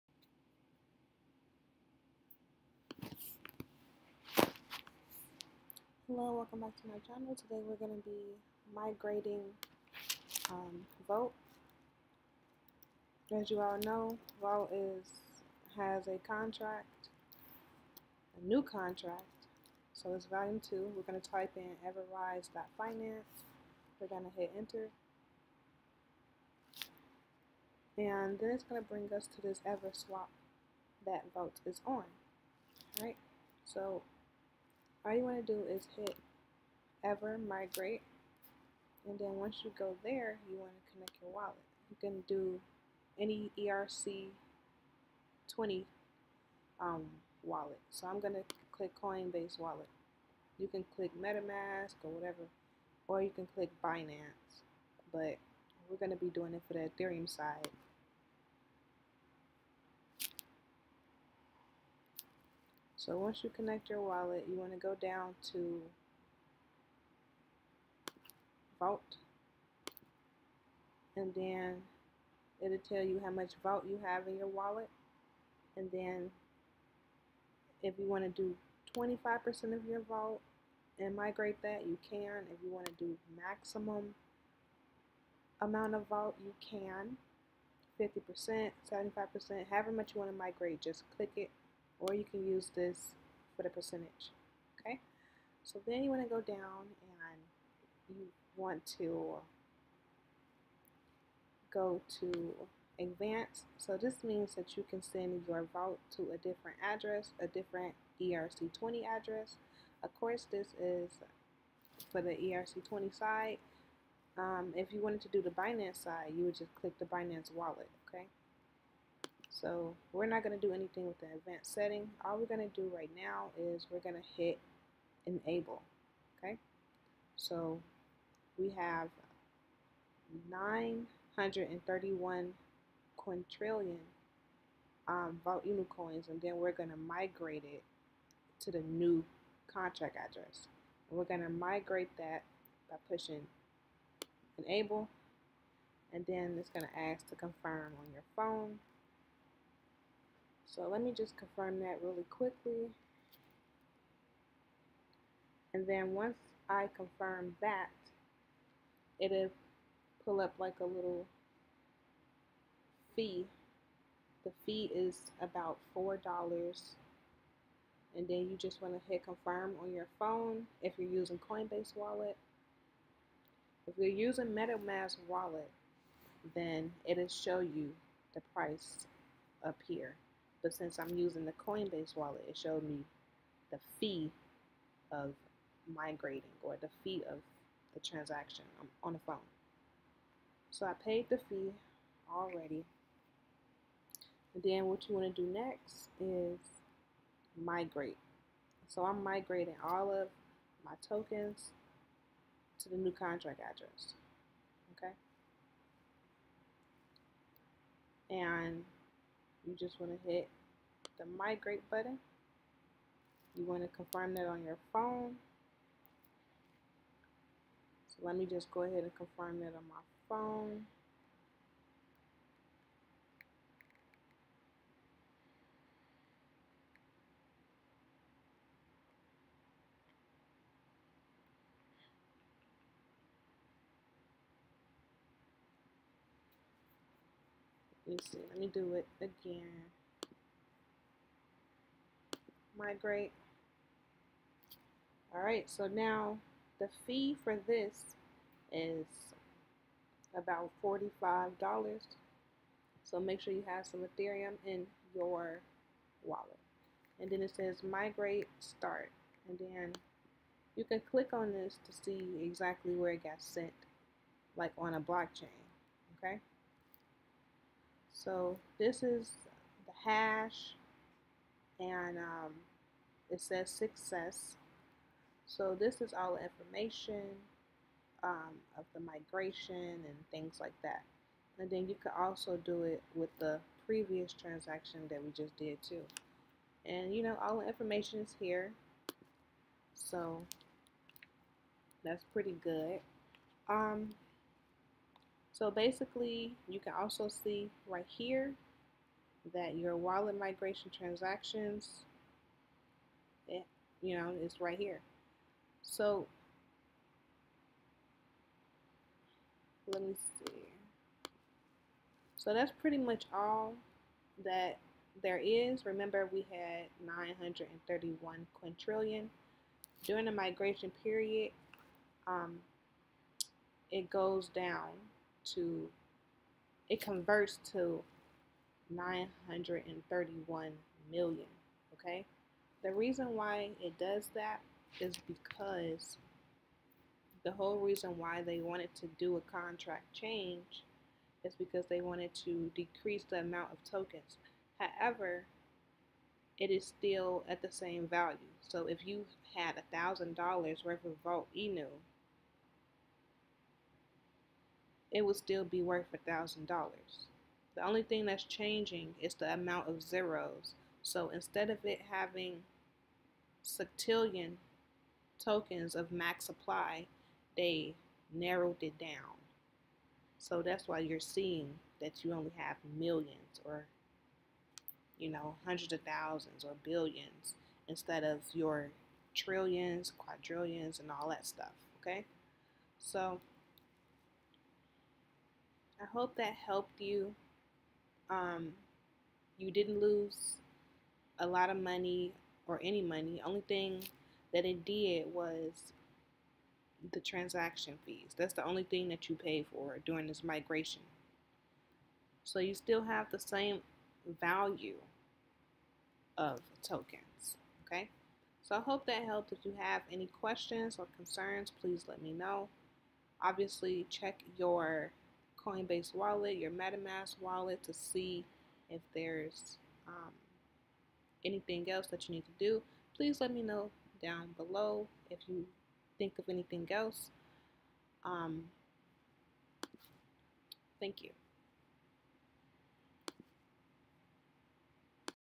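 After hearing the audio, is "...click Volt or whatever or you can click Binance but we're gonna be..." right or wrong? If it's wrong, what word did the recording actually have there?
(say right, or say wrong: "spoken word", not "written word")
wrong: "MetaMask", not "Volt".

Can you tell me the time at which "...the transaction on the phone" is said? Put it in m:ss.
3:07.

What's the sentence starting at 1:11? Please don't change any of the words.
And then it'll tell you how much Volt you have in your wallet.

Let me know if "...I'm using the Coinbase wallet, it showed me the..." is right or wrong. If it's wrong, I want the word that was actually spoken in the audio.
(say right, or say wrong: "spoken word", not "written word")
right.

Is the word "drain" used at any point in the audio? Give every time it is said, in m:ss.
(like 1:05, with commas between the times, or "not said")
not said.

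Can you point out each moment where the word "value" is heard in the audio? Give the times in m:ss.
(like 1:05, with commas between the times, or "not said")
5:48, 6:44.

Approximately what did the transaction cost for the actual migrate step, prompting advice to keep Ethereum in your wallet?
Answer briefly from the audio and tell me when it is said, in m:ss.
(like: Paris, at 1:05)
$45, at 4:10.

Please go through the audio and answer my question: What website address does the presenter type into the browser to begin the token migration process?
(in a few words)
everrise.finance.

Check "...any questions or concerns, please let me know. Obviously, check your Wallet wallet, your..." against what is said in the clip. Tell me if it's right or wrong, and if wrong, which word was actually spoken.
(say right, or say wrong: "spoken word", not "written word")
wrong: "Coinbase", not "Wallet".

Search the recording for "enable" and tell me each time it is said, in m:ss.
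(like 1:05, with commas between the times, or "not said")
2:05, 2:24.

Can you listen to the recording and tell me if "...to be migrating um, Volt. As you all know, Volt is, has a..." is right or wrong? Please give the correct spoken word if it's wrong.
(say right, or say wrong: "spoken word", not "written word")
right.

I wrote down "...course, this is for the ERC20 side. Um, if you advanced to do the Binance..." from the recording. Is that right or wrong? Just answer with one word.
wrong.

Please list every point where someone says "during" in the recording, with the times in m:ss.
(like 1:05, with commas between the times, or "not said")
5:20, 6:40.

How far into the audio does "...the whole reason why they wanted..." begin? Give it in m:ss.
5:37.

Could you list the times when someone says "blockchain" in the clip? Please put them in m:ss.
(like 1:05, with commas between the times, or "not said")
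4:24.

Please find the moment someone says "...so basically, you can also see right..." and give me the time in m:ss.
4:55.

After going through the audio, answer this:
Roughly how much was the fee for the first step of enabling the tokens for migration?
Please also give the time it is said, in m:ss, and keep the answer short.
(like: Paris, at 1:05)
$4, at 2:45.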